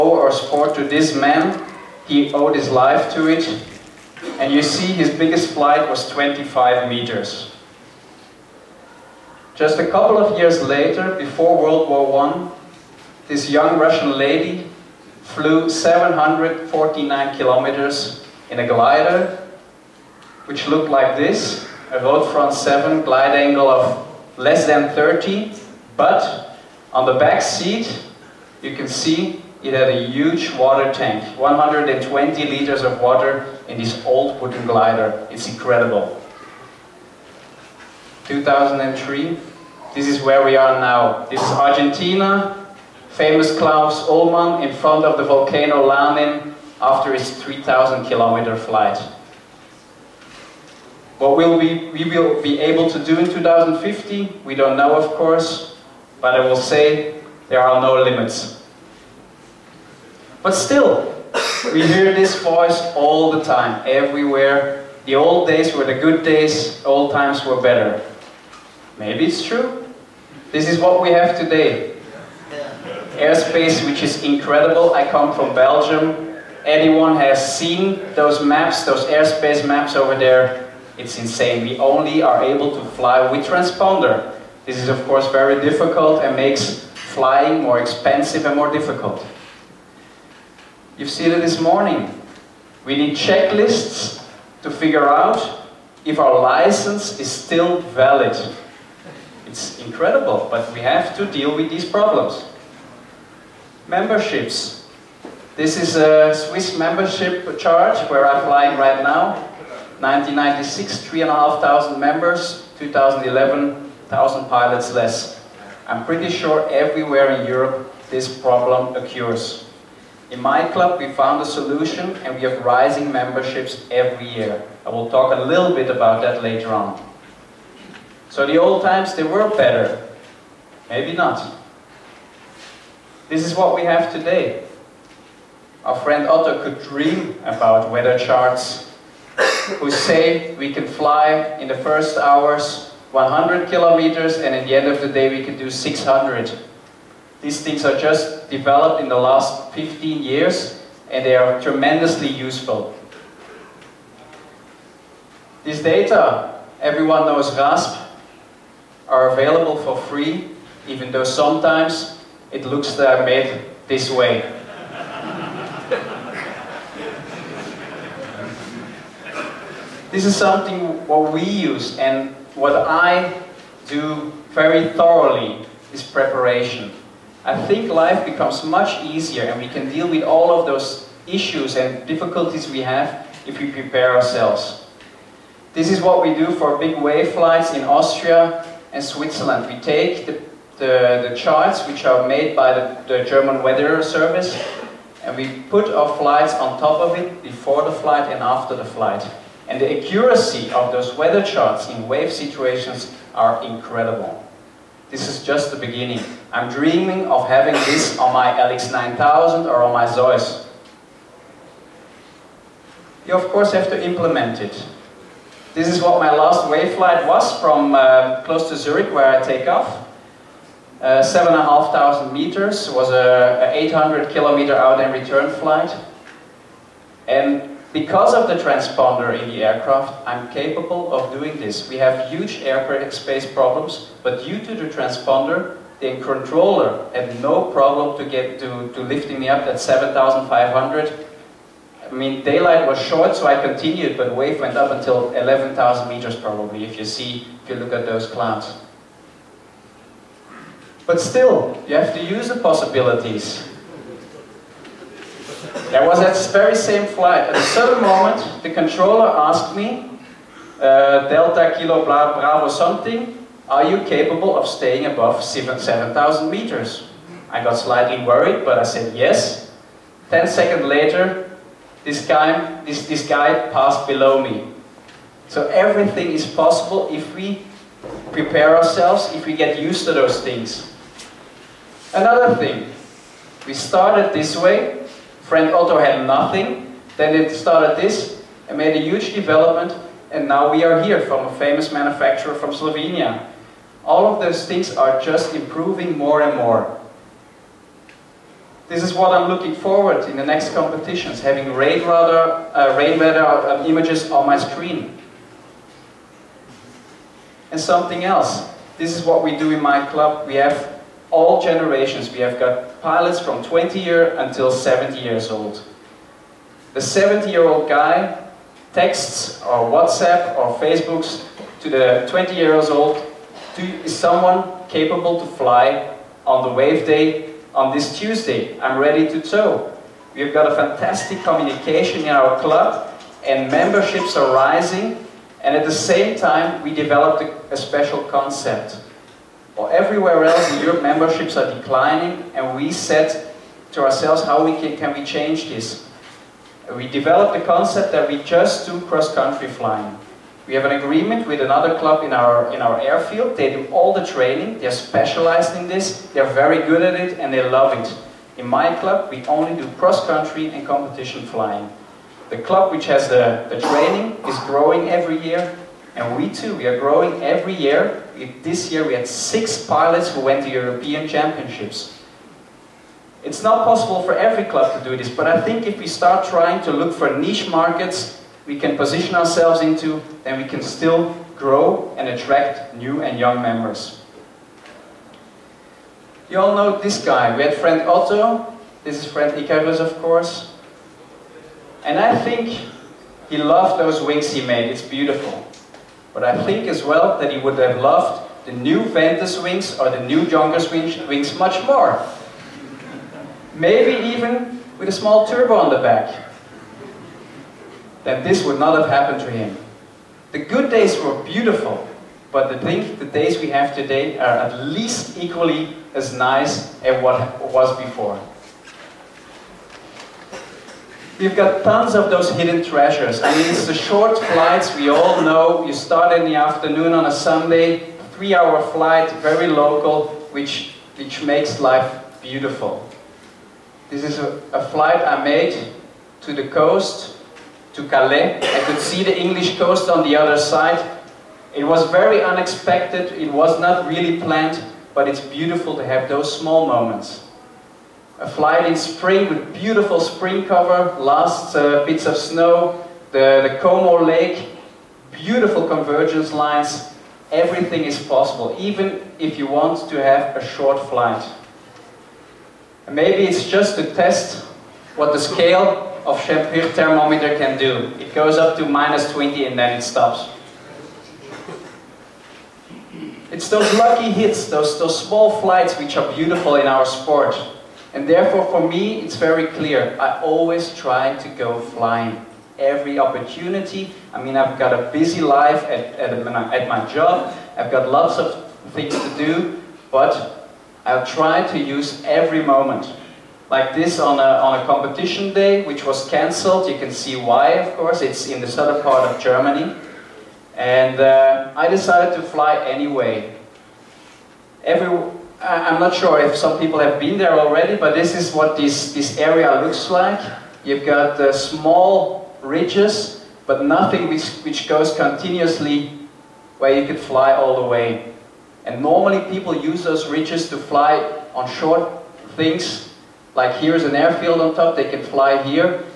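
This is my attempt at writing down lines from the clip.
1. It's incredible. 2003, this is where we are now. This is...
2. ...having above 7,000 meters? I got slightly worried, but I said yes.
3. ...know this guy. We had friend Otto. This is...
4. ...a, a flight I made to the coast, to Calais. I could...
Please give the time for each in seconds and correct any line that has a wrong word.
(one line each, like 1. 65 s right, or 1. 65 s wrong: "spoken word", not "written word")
1. 35 s right
2. 264 s wrong: "staying", not "having"
3. 386 s right
4. 434 s right.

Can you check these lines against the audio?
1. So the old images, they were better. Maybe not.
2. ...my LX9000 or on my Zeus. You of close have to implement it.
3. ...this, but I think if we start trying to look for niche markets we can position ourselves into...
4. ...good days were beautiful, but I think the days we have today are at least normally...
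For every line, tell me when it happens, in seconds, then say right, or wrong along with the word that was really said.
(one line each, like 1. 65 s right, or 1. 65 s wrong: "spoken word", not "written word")
1. 128 s wrong: "times", not "images"
2. 208 s wrong: "course", not "close"
3. 375 s right
4. 410 s wrong: "equally", not "normally".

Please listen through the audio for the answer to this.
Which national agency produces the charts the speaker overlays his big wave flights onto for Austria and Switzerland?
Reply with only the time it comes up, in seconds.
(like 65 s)
193 s.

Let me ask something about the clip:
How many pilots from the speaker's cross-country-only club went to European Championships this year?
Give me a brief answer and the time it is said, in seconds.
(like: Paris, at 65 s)
6, at 369 s.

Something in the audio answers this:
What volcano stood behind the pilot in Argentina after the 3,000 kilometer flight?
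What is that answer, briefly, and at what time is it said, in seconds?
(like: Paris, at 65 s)
Lanin, at 45 s.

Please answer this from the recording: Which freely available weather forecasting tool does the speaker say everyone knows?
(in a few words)
RASP.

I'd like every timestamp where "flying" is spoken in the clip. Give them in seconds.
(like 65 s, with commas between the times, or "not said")
87 s, 108 s, 349 s, 361 s, 481 s.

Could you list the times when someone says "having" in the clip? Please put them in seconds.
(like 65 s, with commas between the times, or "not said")
207 s, 301 s.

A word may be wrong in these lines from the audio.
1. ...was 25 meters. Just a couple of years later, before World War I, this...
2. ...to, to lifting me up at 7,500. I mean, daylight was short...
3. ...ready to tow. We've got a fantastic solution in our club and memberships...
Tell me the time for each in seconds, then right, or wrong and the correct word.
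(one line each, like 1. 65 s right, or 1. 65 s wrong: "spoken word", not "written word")
1. 5 s right
2. 238 s right
3. 328 s wrong: "communication", not "solution".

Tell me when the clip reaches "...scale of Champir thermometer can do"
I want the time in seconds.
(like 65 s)
465 s.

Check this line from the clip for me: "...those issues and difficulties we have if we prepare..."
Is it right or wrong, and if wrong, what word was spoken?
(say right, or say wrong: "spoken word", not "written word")
right.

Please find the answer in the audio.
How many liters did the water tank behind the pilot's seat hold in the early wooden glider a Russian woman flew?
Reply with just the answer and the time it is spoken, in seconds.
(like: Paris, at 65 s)
120 liters, at 31 s.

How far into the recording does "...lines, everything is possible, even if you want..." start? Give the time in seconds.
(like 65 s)
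456 s.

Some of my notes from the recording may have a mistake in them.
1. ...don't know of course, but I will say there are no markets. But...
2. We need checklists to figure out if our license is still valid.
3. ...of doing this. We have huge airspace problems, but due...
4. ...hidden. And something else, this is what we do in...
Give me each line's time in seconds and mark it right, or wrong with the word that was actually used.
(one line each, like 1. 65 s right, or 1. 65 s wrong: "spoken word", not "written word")
1. 54 s wrong: "limits", not "markets"
2. 92 s right
3. 231 s right
4. 304 s wrong: "screen", not "hidden".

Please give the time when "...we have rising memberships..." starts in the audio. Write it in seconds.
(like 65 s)
122 s.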